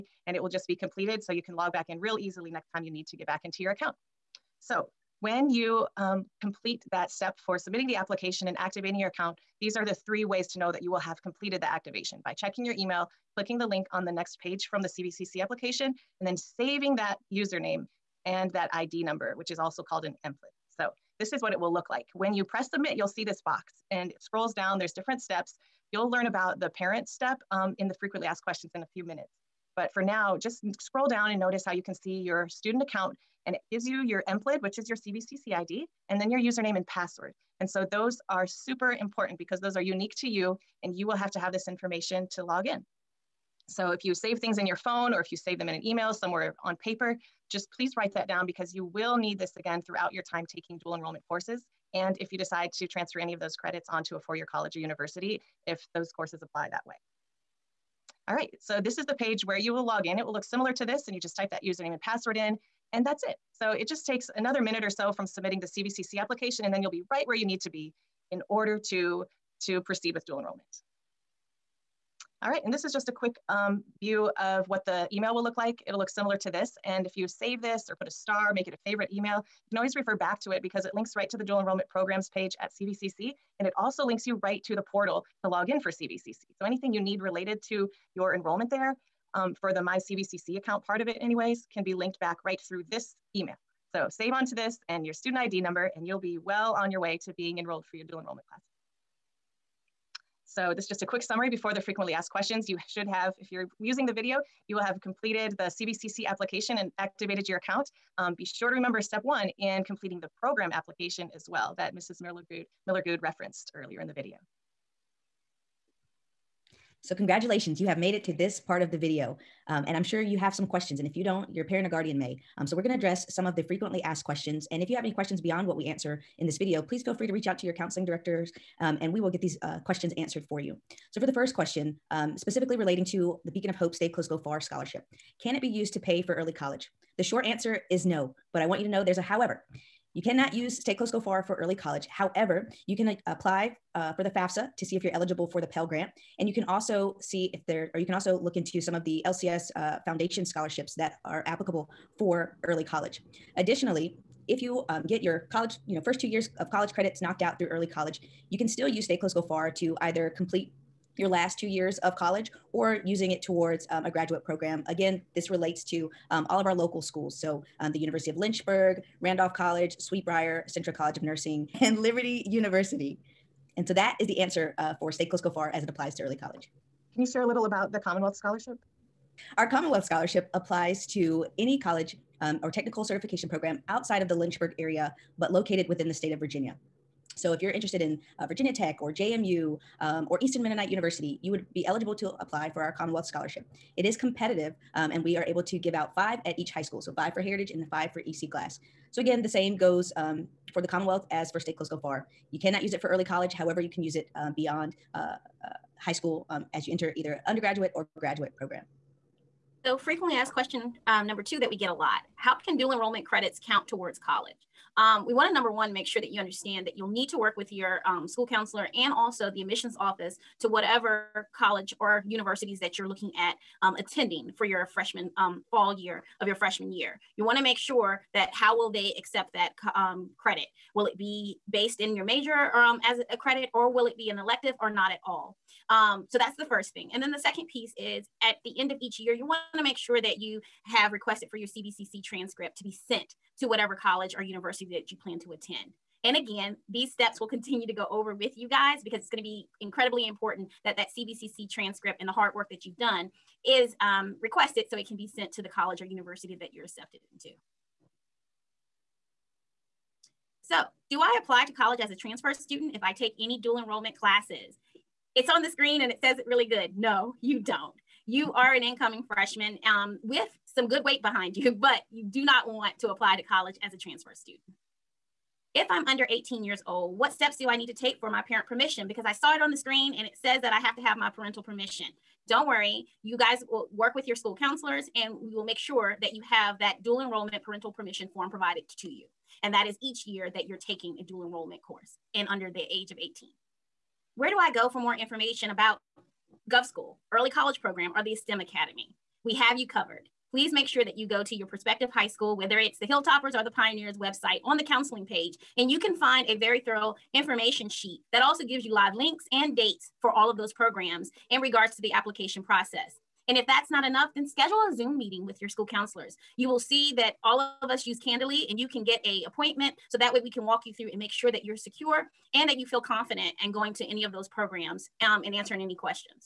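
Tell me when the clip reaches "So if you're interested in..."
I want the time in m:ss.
3:07.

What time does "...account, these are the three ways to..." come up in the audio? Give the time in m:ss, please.
0:09.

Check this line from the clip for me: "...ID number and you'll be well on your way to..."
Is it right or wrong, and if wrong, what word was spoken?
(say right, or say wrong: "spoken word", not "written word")
right.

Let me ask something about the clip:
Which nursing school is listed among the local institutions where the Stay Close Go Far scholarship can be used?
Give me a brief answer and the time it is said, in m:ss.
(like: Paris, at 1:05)
Centra College of Nursing, at 2:50.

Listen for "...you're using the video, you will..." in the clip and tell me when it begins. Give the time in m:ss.
1:43.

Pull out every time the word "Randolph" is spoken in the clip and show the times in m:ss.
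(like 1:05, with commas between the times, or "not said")
2:49.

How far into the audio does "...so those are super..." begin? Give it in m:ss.
0:37.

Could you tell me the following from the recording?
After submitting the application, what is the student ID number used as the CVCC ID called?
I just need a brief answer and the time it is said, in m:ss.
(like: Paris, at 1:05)
EMPLID, at 0:34.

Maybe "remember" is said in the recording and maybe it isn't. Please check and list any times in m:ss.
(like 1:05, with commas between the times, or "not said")
1:48.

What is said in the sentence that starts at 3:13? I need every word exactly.
It is competitive um, and we are able to give out five at each high school.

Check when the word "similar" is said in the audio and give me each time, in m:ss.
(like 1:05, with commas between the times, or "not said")
1:00, 1:16.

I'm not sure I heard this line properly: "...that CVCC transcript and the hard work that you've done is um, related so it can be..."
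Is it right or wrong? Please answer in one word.
wrong.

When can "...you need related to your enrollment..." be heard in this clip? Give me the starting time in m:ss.
1:26.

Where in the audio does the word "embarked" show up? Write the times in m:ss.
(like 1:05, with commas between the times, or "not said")
not said.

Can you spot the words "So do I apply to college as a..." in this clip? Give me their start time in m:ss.
4:20.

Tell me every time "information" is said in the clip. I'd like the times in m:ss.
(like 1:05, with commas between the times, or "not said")
0:41, 4:55, 5:07.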